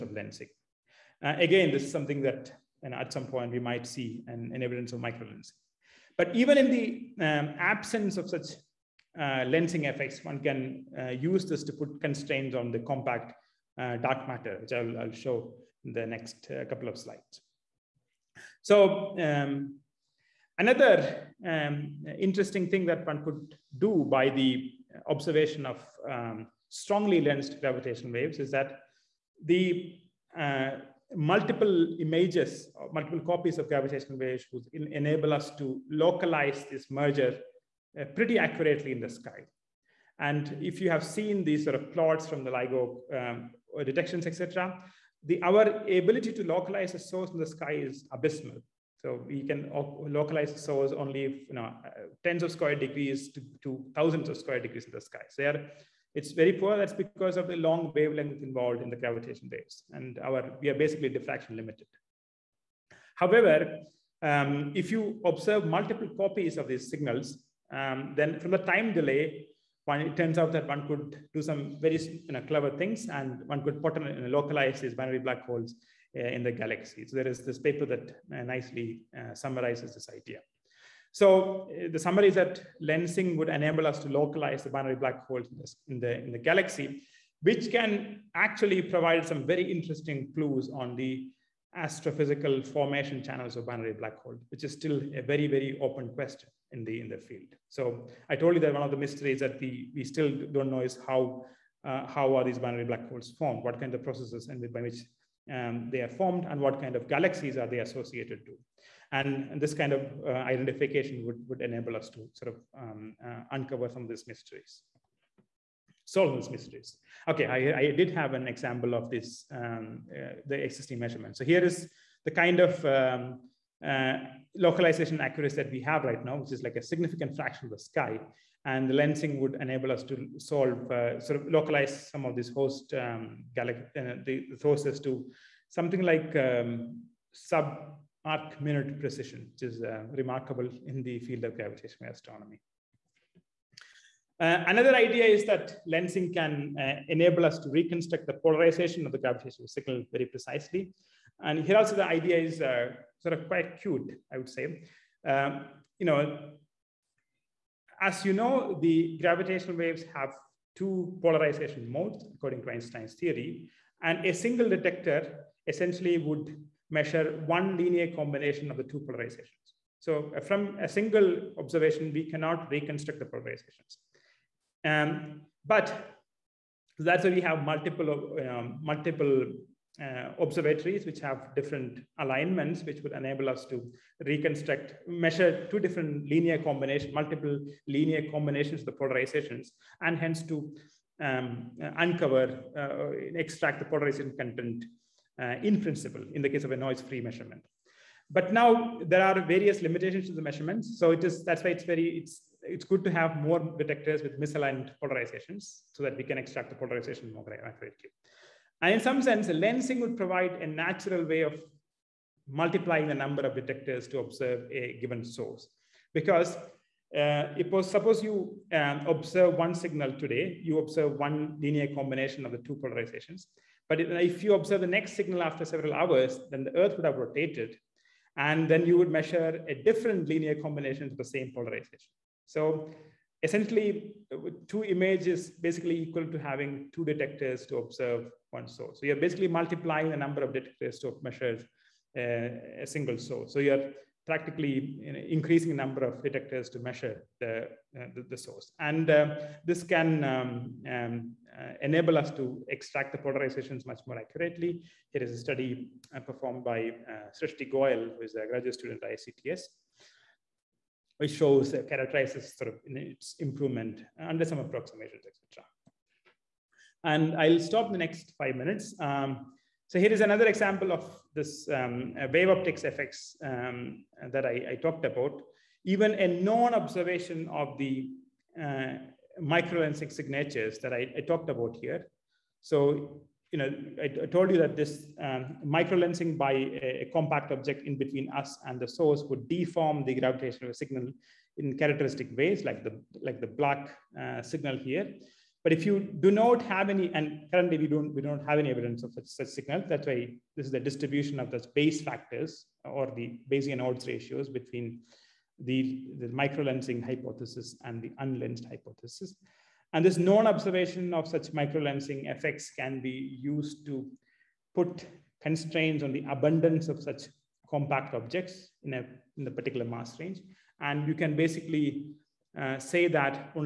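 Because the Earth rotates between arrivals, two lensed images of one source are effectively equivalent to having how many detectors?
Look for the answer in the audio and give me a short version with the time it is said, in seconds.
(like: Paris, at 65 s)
2, at 236 s.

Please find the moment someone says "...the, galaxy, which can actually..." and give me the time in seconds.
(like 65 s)
86 s.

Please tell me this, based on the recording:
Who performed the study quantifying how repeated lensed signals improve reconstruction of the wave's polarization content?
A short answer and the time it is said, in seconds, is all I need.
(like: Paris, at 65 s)
Srishti Goyal, at 257 s.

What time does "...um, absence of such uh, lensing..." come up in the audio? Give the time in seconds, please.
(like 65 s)
7 s.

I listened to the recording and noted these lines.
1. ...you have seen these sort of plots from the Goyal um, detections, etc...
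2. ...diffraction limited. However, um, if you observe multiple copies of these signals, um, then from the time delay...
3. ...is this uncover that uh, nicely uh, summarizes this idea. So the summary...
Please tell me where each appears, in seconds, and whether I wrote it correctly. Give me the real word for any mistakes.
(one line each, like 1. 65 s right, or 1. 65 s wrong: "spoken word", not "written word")
1. 40 s wrong: "LIGO", not "Goyal"
2. 61 s right
3. 77 s wrong: "paper", not "uncover".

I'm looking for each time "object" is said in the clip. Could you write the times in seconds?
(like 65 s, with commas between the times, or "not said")
287 s, 318 s.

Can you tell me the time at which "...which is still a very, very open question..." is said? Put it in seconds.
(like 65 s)
94 s.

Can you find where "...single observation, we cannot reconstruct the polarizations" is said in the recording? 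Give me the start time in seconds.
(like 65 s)
170 s.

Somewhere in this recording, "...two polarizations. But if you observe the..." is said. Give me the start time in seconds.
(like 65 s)
222 s.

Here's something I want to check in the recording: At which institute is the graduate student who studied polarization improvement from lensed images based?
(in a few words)
ICTS.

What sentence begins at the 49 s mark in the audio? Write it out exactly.
So we can localize source only you know, uh, tens of square degrees to, to thousands of square degrees in the sky.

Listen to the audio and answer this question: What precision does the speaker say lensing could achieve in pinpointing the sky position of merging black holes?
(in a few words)
sub arc minute.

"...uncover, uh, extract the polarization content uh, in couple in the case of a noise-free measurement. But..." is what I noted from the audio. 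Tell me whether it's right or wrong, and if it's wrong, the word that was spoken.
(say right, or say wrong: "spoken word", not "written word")
wrong: "principle", not "couple".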